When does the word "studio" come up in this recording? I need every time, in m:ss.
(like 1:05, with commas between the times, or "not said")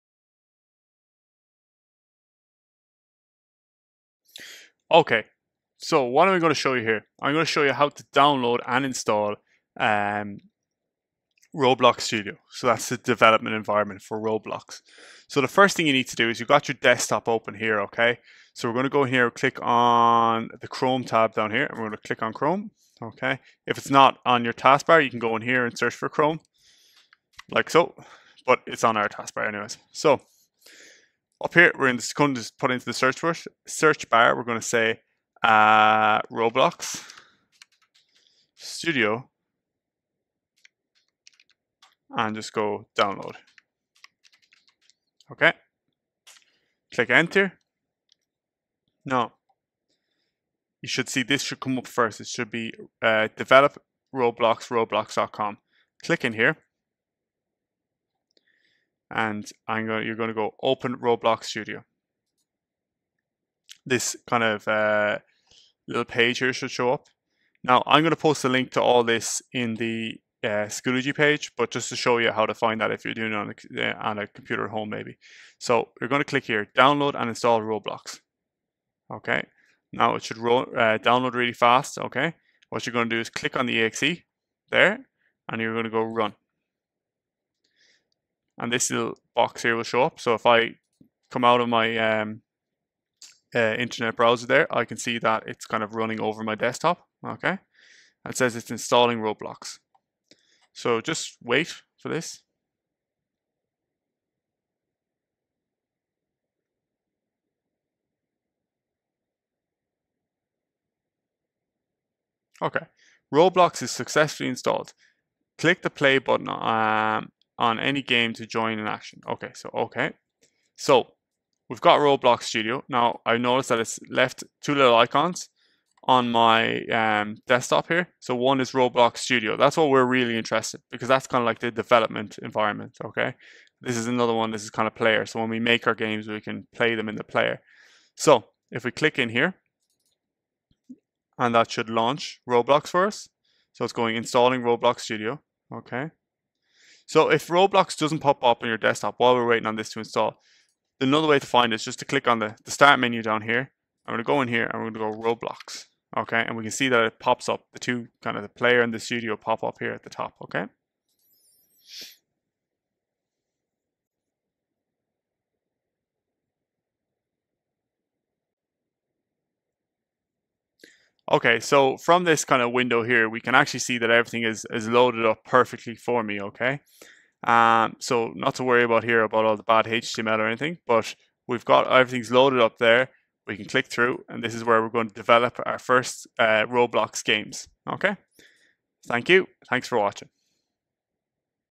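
0:12, 0:38, 1:01, 2:02, 2:09, 2:25, 2:38.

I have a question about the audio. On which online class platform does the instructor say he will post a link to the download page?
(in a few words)
Schoology.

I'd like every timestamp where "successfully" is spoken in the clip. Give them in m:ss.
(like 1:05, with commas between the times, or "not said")
1:53.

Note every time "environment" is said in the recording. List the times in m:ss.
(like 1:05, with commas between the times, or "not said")
0:13, 2:12.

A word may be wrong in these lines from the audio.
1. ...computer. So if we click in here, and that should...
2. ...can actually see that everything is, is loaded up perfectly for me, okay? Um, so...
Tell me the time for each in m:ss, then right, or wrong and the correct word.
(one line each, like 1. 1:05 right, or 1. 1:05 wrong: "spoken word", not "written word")
1. 2:17 wrong: "player", not "computer"
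2. 2:53 right.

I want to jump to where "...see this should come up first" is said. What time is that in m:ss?
0:51.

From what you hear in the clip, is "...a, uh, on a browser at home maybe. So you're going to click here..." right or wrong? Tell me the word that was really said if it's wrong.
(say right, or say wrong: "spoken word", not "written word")
wrong: "computer", not "browser".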